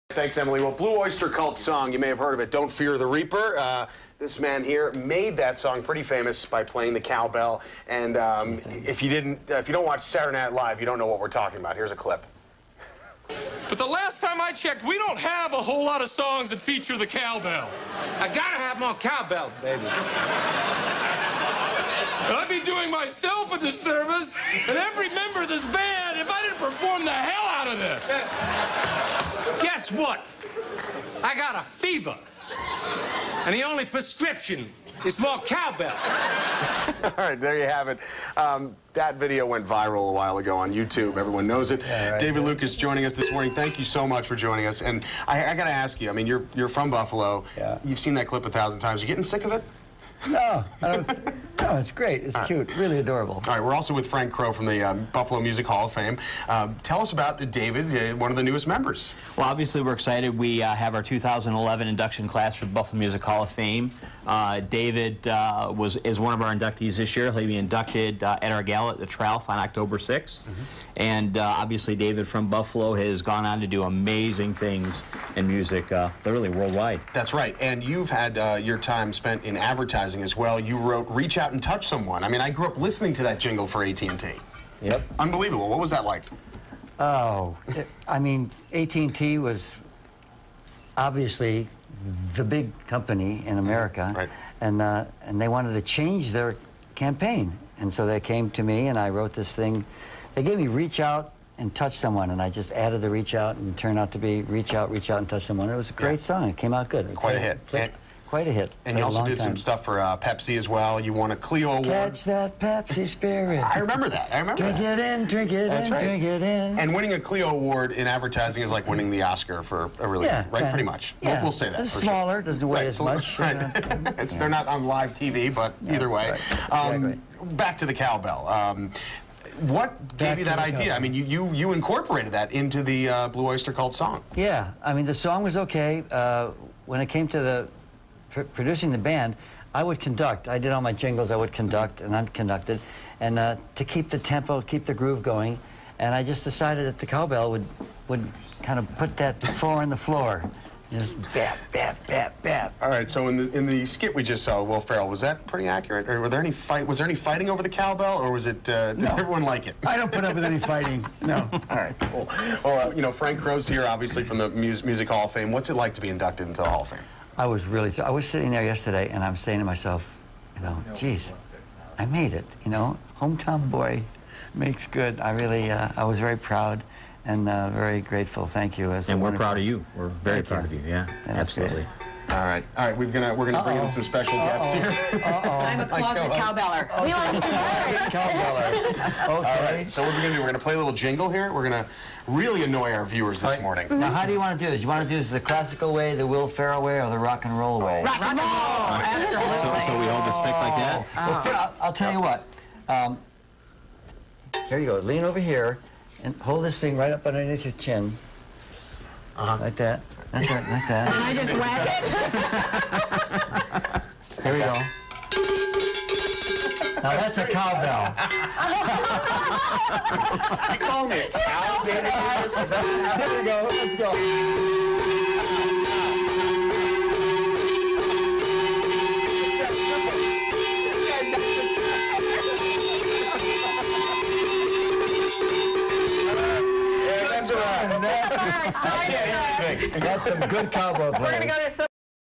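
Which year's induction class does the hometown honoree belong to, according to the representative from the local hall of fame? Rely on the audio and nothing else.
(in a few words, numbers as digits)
2011.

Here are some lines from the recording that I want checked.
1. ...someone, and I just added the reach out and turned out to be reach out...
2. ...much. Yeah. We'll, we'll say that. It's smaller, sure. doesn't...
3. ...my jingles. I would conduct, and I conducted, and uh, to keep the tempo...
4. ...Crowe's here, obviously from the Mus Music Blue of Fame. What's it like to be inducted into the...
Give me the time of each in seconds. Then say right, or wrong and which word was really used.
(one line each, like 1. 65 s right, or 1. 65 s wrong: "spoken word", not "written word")
1. 101 s right
2. 120 s right
3. 140 s right
4. 163 s wrong: "Hall", not "Blue".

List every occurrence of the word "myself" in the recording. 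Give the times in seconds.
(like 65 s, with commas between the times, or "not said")
22 s, 169 s.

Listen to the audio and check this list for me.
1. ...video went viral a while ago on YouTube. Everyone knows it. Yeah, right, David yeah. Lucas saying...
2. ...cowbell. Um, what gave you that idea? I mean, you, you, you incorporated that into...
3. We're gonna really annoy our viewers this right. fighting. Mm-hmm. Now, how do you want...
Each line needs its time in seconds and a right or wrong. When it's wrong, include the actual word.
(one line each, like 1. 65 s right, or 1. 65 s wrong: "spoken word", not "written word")
1. 39 s wrong: "joining", not "saying"
2. 127 s right
3. 191 s wrong: "morning", not "fighting".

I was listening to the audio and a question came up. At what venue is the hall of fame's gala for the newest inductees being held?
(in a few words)
The Trough.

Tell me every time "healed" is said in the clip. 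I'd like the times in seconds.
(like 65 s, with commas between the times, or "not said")
not said.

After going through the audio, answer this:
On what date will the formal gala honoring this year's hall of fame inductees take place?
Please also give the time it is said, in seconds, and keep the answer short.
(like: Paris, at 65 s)
October 6, at 69 s.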